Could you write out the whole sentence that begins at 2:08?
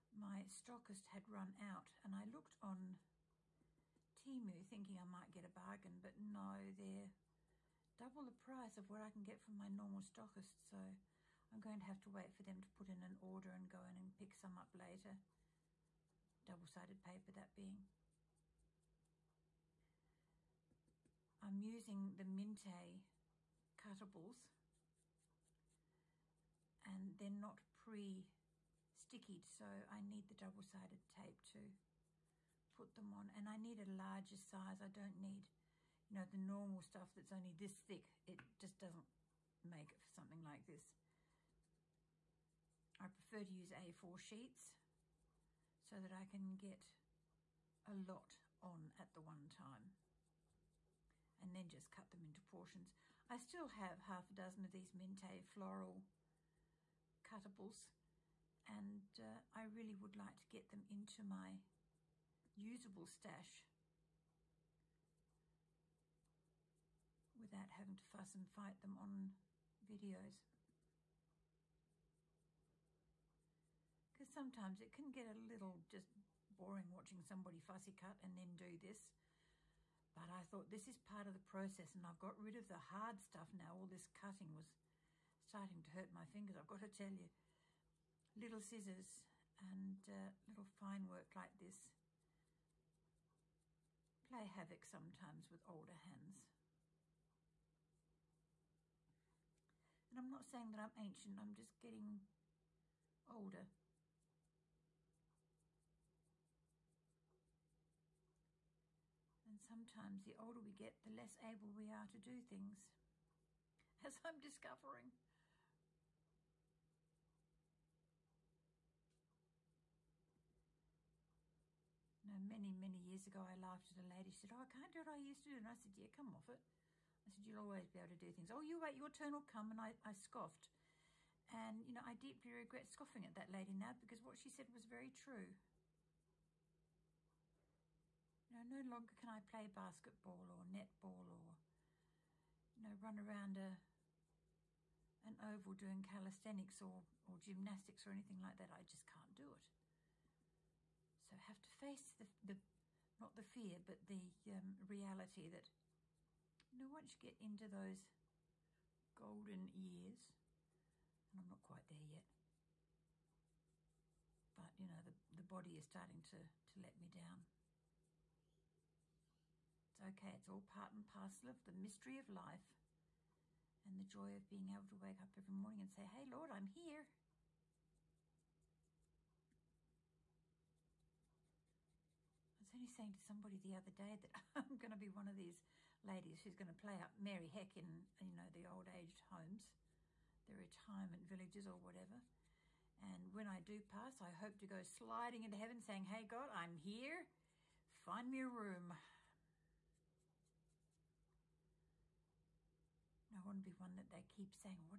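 Oh, you wait, your turn will come.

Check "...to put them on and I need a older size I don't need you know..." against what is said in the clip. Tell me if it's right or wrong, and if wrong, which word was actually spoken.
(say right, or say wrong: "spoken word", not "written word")
wrong: "larger", not "older".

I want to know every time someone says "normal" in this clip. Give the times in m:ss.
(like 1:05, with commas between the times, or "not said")
0:09, 0:36.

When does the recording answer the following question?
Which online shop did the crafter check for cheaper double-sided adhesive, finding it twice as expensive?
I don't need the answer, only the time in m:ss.
0:04.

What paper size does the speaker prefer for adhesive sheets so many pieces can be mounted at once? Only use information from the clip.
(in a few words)
A4.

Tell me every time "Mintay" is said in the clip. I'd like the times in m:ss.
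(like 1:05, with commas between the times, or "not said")
0:22, 0:54.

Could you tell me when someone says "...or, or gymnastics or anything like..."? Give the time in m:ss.
2:26.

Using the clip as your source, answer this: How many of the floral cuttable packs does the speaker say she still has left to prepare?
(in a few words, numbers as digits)
half a dozen.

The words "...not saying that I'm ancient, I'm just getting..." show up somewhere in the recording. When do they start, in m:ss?
1:40.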